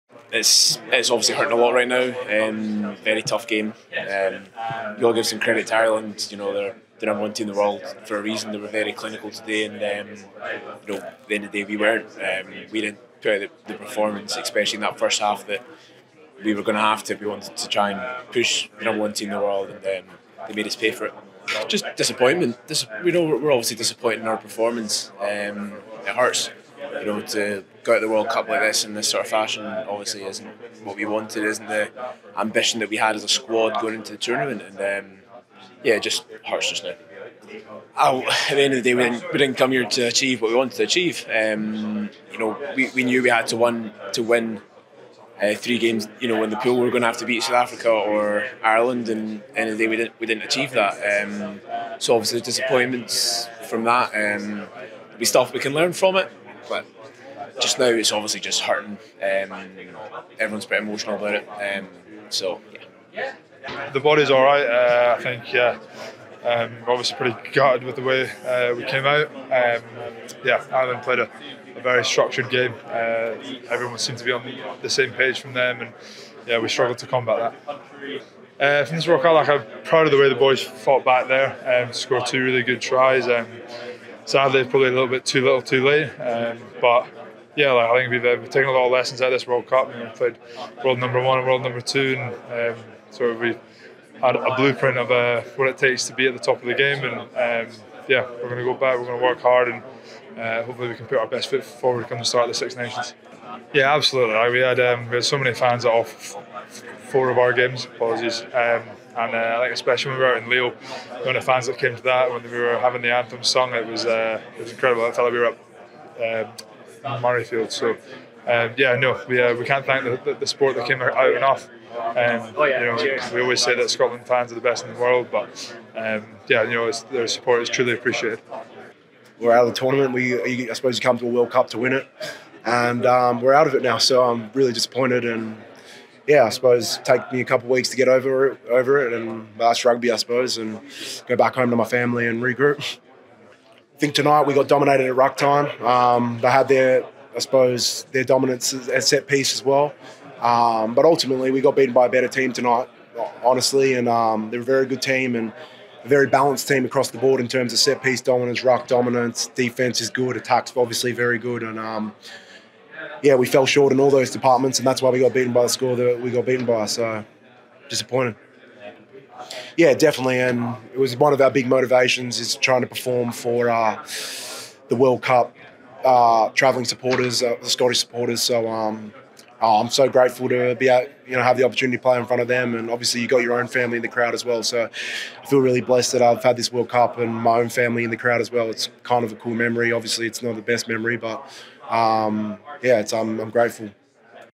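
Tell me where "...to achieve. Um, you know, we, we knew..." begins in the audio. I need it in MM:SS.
00:40.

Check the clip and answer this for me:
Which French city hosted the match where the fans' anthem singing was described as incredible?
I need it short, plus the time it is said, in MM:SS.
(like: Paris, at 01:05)
Lille, at 01:50.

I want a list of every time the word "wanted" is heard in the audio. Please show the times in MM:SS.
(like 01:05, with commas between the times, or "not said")
00:17, 00:31, 00:40.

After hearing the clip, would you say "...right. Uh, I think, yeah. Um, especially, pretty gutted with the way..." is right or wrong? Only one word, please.
wrong.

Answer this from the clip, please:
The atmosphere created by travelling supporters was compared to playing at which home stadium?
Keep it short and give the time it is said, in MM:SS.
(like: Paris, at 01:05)
Murrayfield, at 01:57.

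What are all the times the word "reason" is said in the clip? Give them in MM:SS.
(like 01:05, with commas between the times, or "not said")
00:08.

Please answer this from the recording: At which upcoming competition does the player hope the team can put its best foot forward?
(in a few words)
Six Nations.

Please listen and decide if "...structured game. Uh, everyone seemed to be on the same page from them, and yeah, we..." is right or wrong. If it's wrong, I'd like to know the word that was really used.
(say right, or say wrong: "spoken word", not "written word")
right.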